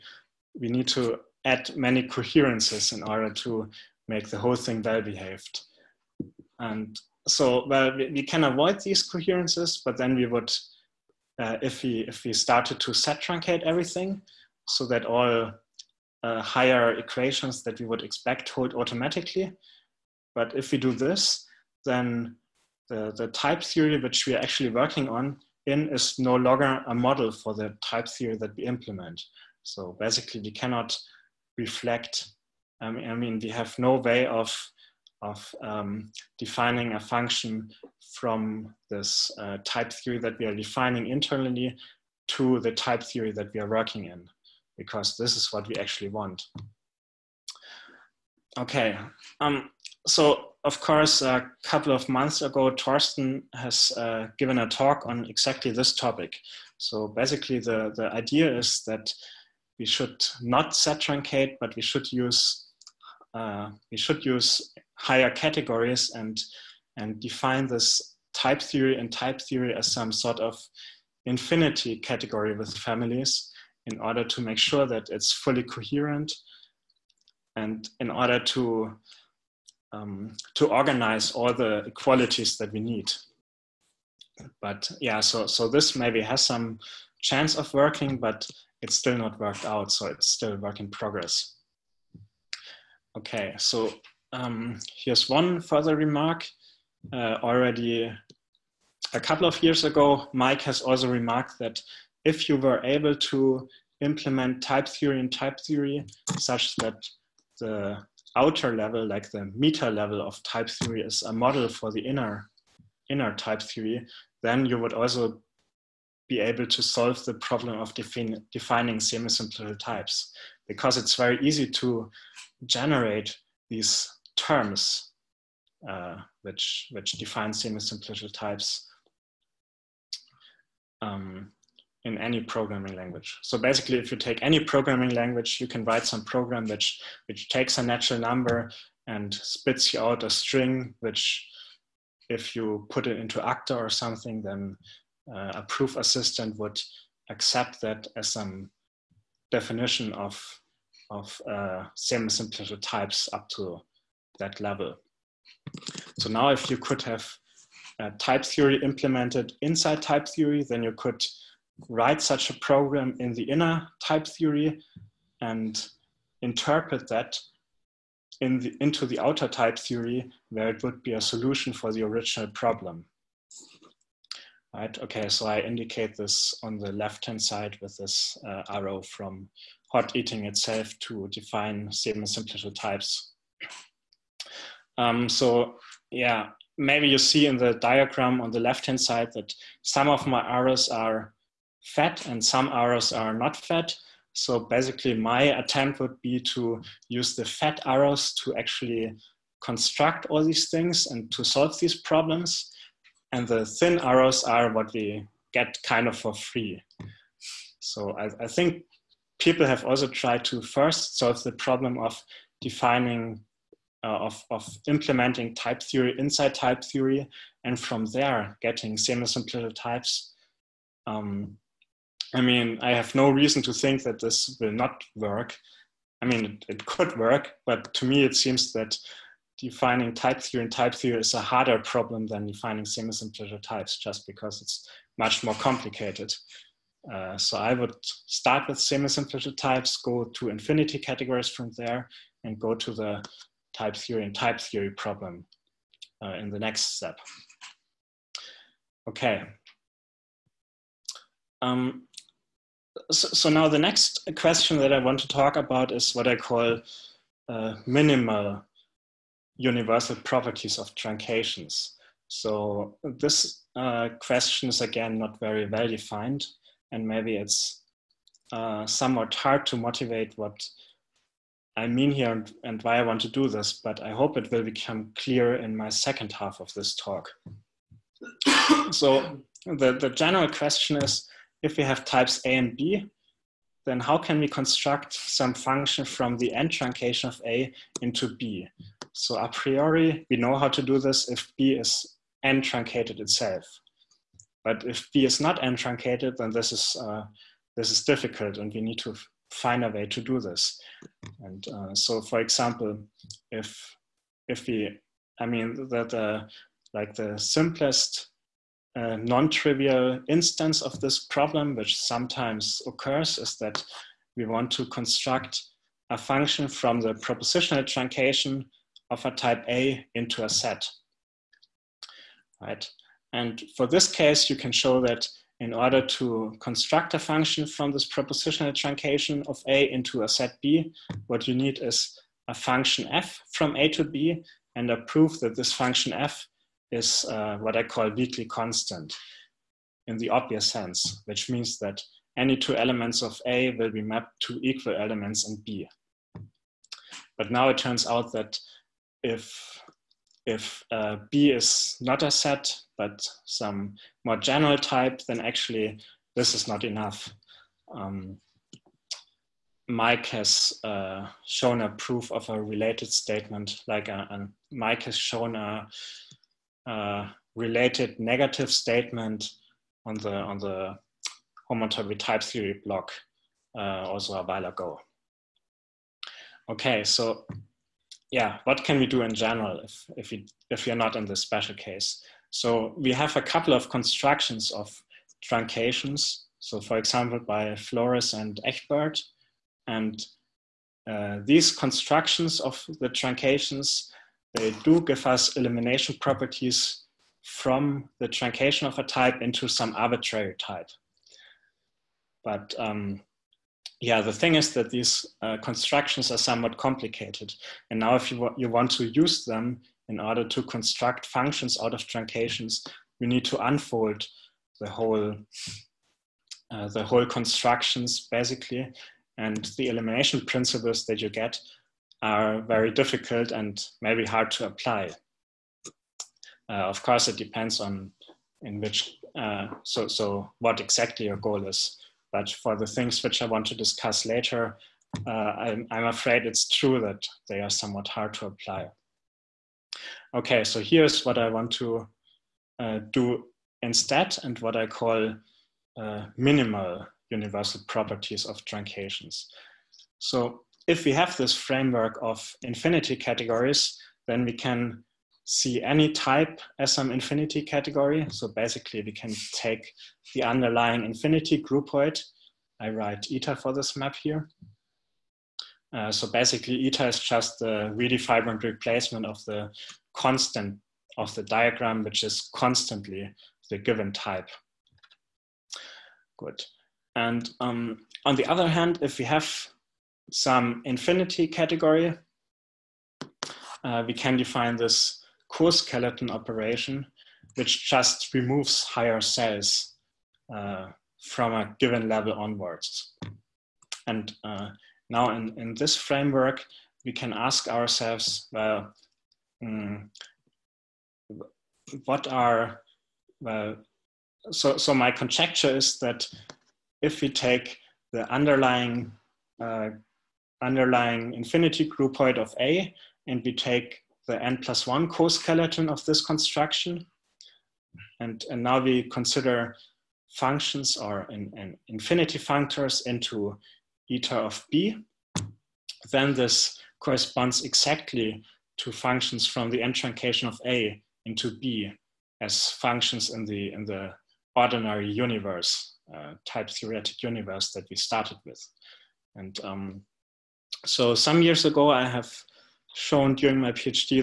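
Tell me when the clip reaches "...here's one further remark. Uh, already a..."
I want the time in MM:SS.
01:34.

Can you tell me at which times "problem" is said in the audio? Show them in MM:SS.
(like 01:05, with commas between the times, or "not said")
01:57, 02:52, 03:22, 03:31, 03:51, 04:04, 05:11.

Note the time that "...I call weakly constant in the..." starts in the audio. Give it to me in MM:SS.
05:37.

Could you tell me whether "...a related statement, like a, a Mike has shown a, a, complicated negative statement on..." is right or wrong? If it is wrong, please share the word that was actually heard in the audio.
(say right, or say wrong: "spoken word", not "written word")
wrong: "related", not "complicated".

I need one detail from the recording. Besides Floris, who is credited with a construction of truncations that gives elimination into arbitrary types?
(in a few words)
Egbert.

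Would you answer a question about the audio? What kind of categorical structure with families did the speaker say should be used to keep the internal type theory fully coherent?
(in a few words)
infinity category with families.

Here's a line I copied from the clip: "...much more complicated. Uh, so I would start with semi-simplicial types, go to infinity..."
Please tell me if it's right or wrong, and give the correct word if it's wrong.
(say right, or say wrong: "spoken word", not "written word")
right.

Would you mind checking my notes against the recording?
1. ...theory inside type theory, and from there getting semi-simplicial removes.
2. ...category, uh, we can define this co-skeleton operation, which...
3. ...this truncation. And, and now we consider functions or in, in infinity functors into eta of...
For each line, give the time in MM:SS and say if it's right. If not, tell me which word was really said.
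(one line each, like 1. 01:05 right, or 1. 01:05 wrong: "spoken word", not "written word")
1. 03:35 wrong: "types", not "removes"
2. 08:01 right
3. 08:36 wrong: "construction", not "truncation".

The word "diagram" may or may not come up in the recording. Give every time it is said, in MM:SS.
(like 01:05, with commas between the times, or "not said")
03:07, 07:51.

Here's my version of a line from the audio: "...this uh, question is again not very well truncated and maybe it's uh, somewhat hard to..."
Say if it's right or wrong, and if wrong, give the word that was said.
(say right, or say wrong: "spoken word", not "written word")
wrong: "defined", not "truncated".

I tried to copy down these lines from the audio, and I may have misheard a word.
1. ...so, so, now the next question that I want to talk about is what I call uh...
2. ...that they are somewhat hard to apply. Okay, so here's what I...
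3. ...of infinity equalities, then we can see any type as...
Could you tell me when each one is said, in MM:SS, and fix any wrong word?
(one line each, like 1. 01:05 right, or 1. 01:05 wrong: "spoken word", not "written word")
1. 04:13 right
2. 07:17 right
3. 07:32 wrong: "categories", not "equalities".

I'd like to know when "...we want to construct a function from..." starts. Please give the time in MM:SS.
05:14.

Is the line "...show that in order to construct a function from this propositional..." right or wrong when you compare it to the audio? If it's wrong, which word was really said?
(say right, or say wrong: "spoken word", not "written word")
right.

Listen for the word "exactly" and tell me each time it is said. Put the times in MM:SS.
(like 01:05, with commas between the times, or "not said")
00:55, 07:10, 08:47.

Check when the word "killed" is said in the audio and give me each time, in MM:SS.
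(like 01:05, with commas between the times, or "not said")
not said.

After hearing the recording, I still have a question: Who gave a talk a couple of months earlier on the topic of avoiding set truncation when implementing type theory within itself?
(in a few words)
Torsten.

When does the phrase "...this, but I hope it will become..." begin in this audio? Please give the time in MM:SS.
04:33.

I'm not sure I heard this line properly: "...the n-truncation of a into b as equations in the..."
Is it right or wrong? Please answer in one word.
wrong.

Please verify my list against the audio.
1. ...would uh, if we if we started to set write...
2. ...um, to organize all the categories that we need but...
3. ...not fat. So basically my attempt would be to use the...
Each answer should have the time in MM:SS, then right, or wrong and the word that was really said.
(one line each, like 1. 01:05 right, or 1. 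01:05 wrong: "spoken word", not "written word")
1. 00:10 wrong: "truncate", not "write"
2. 01:19 wrong: "equalities", not "categories"
3. 03:13 right.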